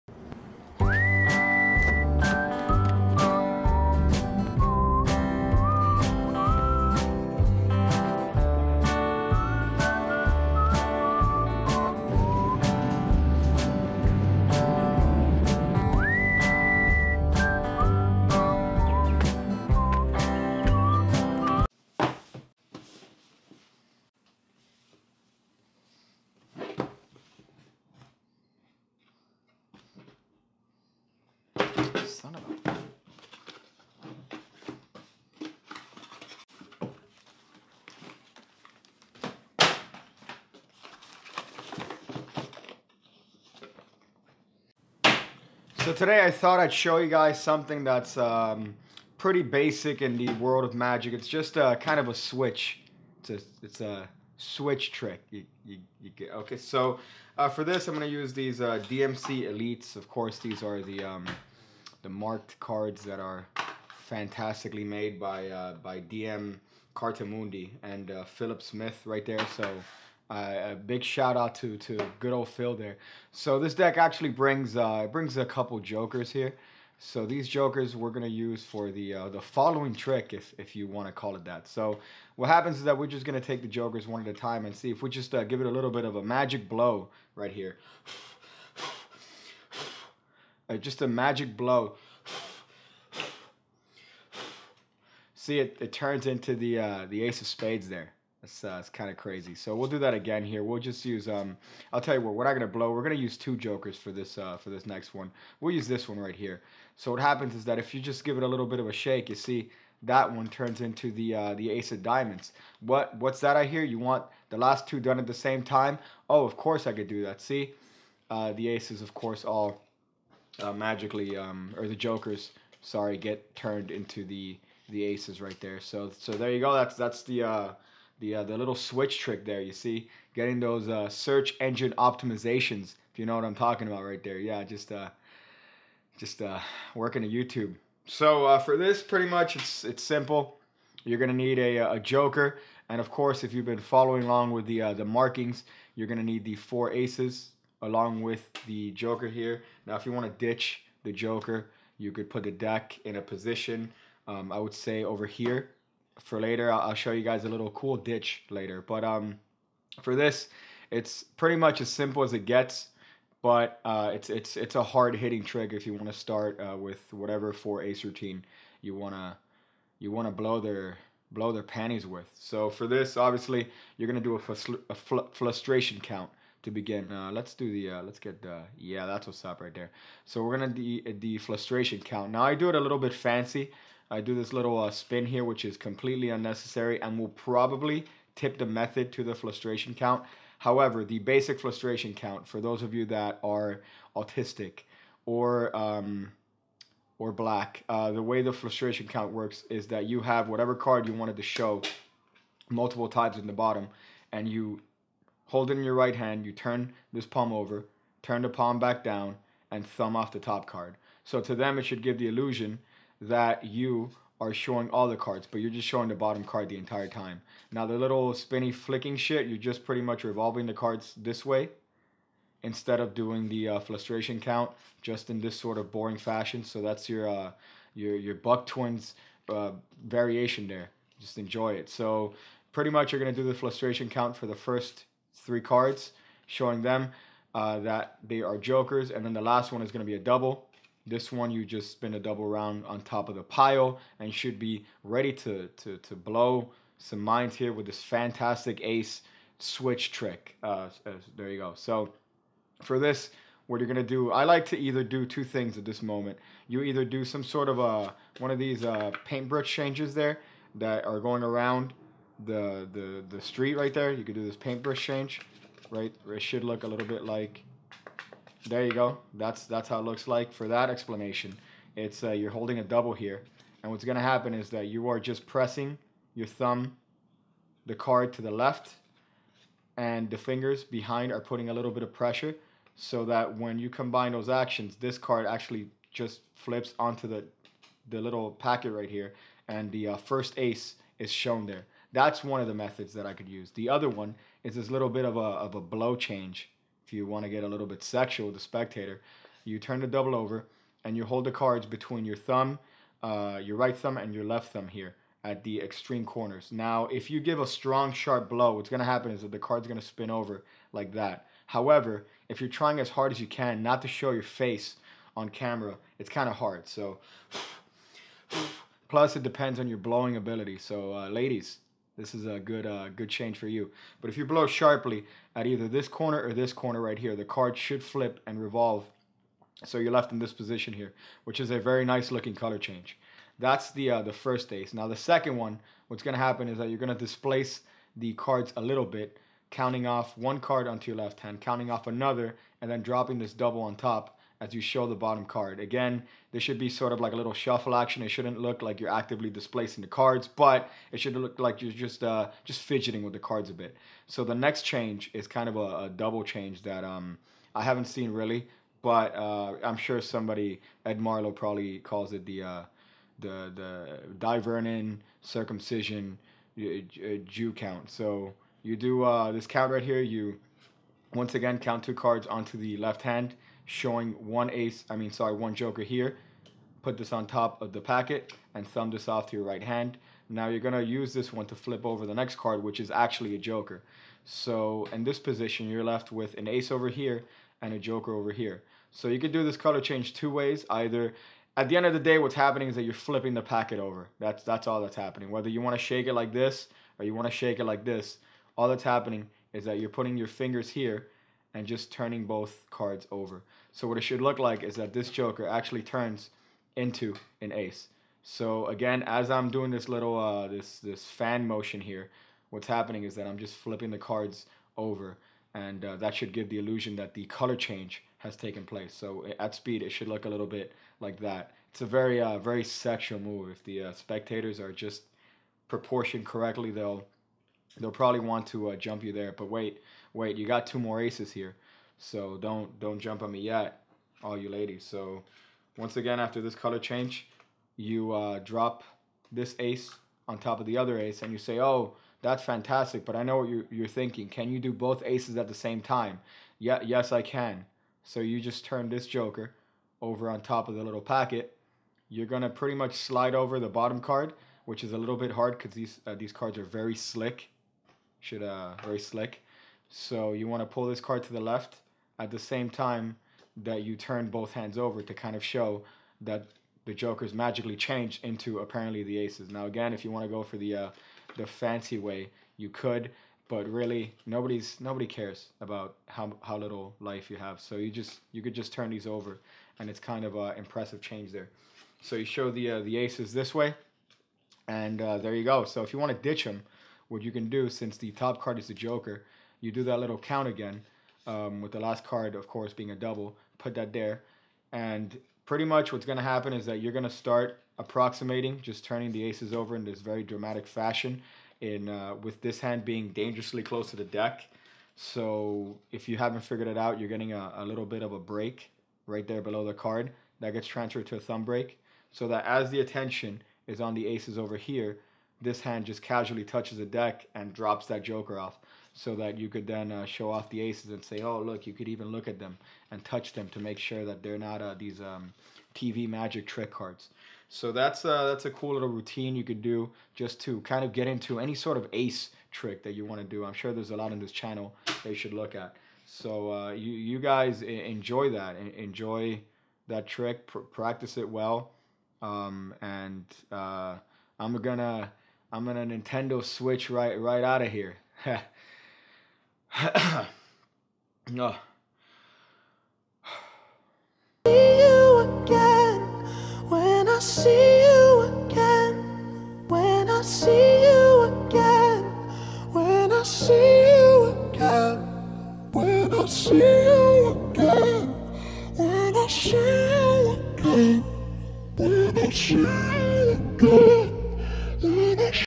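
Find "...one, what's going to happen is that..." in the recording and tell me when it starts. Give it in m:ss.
5:35.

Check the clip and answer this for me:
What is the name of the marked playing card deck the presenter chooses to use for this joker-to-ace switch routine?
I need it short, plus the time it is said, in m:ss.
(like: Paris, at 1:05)
DMC Elites, at 0:58.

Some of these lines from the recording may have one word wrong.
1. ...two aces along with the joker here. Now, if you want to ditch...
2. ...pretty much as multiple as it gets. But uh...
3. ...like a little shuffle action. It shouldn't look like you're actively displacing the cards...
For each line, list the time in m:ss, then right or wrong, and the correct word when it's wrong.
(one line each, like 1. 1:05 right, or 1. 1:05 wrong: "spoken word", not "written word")
1. 2:26 wrong: "four", not "two"
2. 2:41 wrong: "simple", not "multiple"
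3. 5:47 right.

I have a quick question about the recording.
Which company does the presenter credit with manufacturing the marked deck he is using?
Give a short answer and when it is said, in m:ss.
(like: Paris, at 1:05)
DM Cartamundi, at 1:05.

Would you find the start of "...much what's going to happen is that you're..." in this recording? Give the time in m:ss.
8:15.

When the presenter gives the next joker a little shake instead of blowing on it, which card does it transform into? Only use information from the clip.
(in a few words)
Ace of diamonds.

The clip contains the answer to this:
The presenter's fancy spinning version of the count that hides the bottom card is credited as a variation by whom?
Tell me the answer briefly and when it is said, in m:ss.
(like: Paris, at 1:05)
Buck Twins, at 3:48.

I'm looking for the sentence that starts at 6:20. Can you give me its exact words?
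Now you're going to use this one to flip over the next card, which is actually a joker.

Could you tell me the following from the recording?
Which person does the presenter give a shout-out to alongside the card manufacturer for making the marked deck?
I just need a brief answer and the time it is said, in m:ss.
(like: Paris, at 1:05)
Philip Smith, at 1:08.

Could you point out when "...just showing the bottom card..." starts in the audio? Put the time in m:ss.
3:35.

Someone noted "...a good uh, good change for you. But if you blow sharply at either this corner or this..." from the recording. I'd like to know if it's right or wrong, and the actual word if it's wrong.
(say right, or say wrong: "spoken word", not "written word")
right.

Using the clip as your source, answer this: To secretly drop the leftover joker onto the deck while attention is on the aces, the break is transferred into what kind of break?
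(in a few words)
Thumb break.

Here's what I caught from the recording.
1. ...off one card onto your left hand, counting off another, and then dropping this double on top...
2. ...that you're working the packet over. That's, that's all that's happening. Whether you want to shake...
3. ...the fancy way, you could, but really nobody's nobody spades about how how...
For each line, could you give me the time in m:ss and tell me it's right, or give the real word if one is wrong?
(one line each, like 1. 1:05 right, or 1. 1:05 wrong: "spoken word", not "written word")
1. 5:40 right
2. 6:32 wrong: "flipping", not "working"
3. 7:51 wrong: "cares", not "spades".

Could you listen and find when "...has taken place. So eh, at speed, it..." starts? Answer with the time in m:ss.
6:58.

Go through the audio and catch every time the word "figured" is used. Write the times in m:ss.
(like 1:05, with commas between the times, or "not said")
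8:26.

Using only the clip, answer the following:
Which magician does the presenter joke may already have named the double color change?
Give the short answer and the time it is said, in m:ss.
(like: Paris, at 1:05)
Ed Marlo, at 6:01.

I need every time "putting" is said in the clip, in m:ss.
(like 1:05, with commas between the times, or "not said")
4:41, 6:40.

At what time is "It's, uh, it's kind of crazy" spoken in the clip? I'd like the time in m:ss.
1:38.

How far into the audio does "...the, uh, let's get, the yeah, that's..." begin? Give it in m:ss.
2:57.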